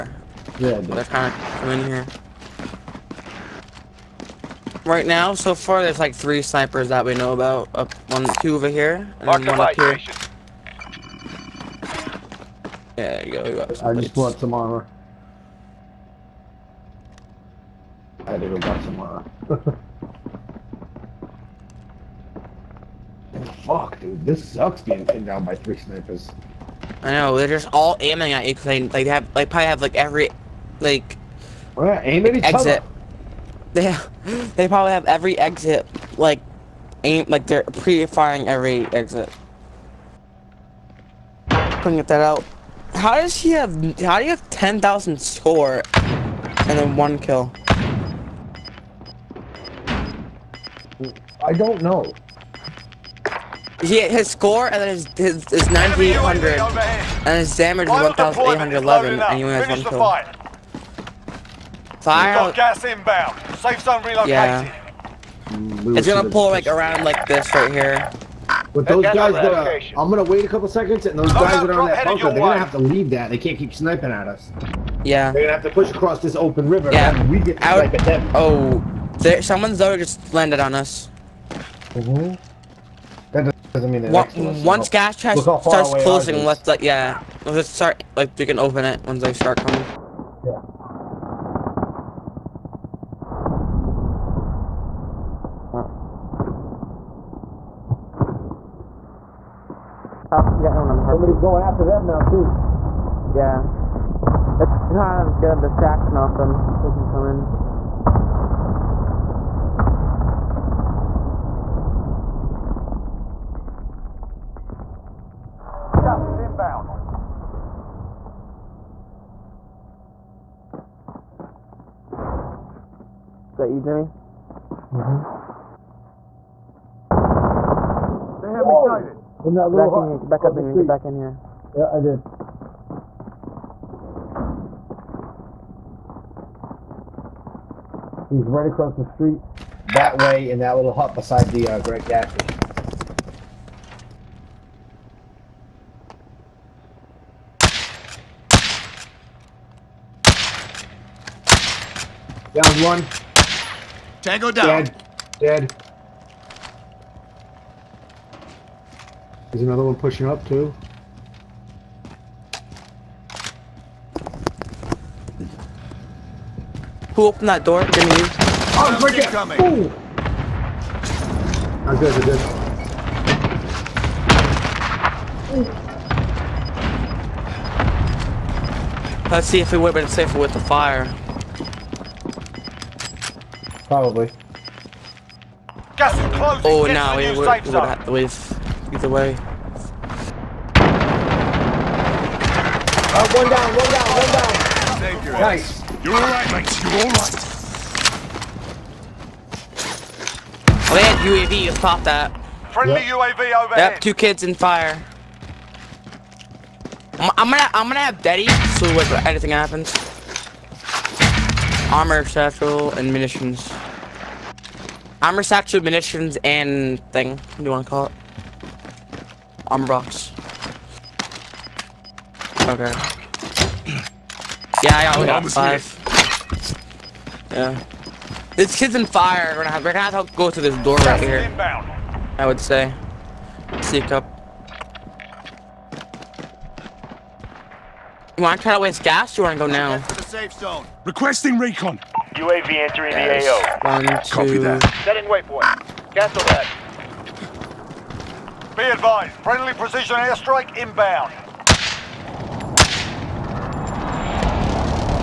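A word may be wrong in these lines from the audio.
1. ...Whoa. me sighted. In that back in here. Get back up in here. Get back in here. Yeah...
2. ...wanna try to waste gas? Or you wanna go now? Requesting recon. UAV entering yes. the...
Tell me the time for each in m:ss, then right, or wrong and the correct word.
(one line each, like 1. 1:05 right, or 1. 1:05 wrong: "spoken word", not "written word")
1. 2:08 right
2. 3:58 right.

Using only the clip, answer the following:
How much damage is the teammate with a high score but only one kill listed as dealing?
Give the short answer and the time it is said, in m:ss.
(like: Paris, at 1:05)
1811, at 0:57.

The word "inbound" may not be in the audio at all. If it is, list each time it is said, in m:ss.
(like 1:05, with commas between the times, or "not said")
1:02, 1:56, 4:10.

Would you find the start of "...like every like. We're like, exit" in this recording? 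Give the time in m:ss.
0:29.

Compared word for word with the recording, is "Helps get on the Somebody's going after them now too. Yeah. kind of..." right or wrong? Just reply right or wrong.
right.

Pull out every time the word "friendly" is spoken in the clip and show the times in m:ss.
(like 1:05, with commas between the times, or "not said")
3:22, 4:09.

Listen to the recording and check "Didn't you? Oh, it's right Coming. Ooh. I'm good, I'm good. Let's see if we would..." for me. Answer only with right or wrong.
right.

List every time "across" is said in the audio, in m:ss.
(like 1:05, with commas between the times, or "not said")
1:15, 2:18.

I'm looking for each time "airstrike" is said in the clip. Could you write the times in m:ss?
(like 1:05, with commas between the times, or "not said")
4:10.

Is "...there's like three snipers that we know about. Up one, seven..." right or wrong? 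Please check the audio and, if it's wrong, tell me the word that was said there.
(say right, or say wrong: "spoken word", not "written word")
wrong: "two", not "seven".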